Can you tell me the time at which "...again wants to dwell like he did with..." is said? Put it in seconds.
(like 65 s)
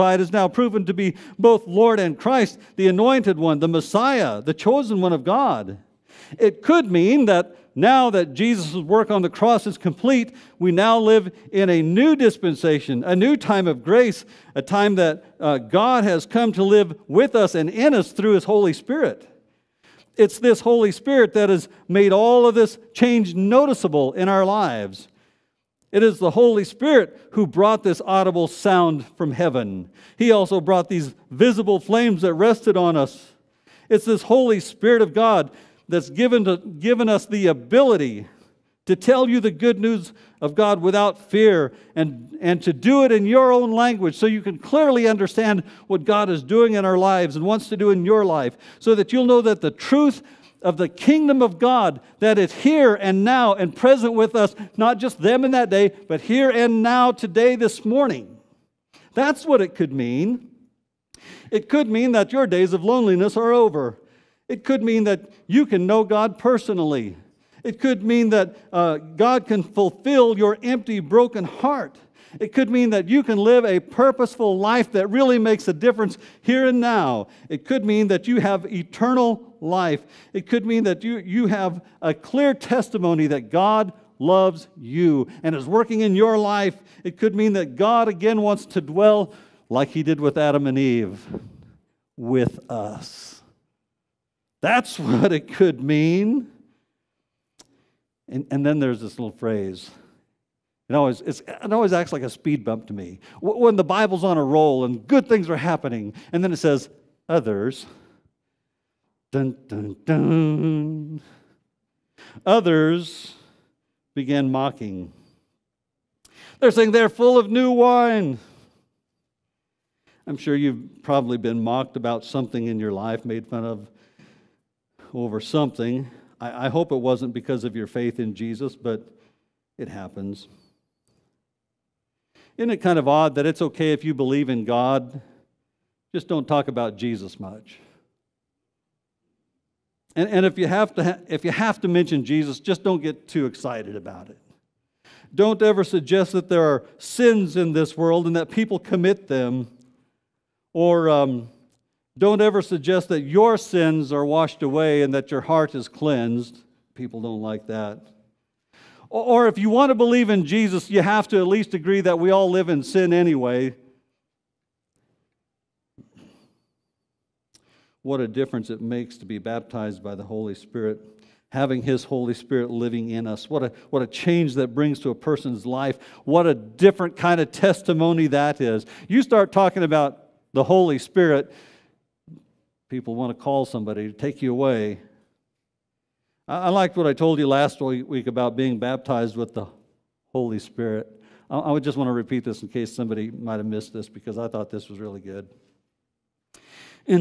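88 s.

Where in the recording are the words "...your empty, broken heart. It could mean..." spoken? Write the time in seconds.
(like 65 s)
70 s.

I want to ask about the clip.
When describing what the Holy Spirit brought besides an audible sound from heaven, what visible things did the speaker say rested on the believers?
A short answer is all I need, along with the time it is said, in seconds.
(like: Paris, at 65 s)
flames, at 31 s.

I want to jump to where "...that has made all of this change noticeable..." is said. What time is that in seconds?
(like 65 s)
21 s.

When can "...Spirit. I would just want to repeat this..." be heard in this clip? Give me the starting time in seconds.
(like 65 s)
190 s.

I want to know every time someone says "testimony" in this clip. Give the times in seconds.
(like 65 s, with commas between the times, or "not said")
82 s, 177 s.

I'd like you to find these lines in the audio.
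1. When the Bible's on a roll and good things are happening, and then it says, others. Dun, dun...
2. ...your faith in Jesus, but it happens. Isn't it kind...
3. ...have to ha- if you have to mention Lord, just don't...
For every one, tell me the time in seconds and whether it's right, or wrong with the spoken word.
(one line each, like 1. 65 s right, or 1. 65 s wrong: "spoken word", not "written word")
1. 103 s right
2. 127 s right
3. 140 s wrong: "Jesus", not "Lord".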